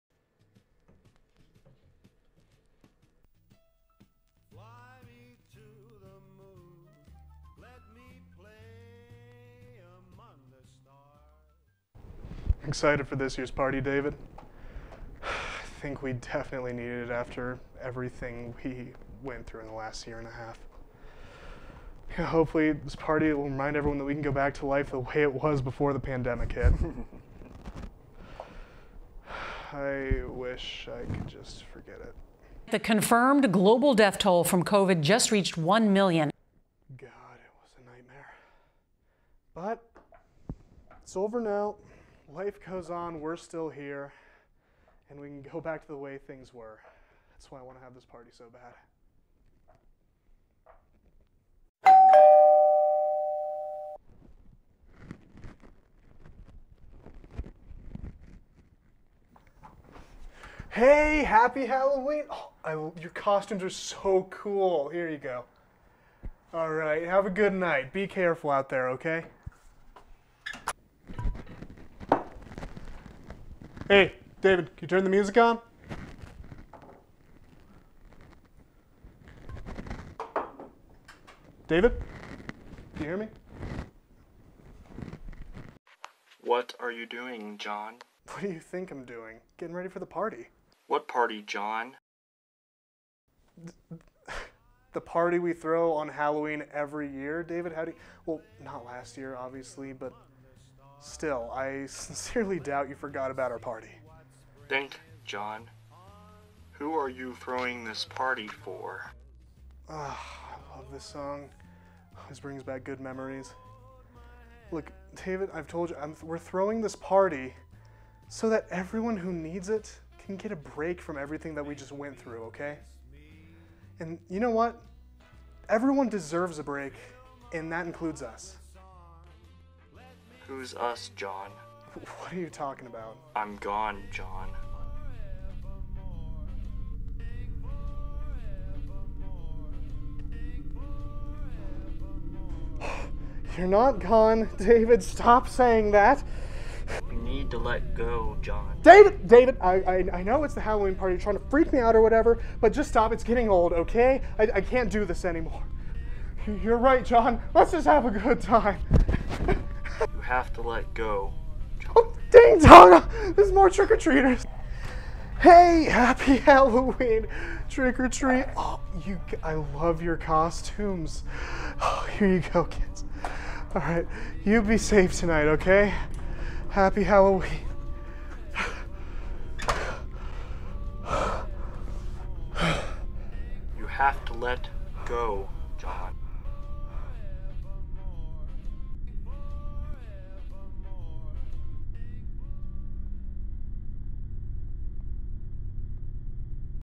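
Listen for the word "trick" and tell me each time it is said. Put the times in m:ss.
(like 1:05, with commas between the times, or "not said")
2:43, 2:47.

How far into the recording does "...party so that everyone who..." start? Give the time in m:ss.
1:56.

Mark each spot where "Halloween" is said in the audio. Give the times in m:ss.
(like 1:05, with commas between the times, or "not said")
1:01, 1:36, 2:30, 2:46, 2:57.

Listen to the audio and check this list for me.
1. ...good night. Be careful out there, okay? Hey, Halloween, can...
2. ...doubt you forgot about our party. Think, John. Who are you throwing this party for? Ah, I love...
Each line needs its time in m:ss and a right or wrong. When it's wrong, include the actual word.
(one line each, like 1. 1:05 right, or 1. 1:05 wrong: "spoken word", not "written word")
1. 1:07 wrong: "David", not "Halloween"
2. 1:42 right.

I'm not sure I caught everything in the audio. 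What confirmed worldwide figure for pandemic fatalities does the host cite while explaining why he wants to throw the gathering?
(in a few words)
1 million.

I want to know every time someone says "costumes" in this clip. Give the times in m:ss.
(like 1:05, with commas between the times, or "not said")
1:03, 2:50.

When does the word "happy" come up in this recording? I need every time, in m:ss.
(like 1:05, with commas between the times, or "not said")
1:01, 2:45, 2:56.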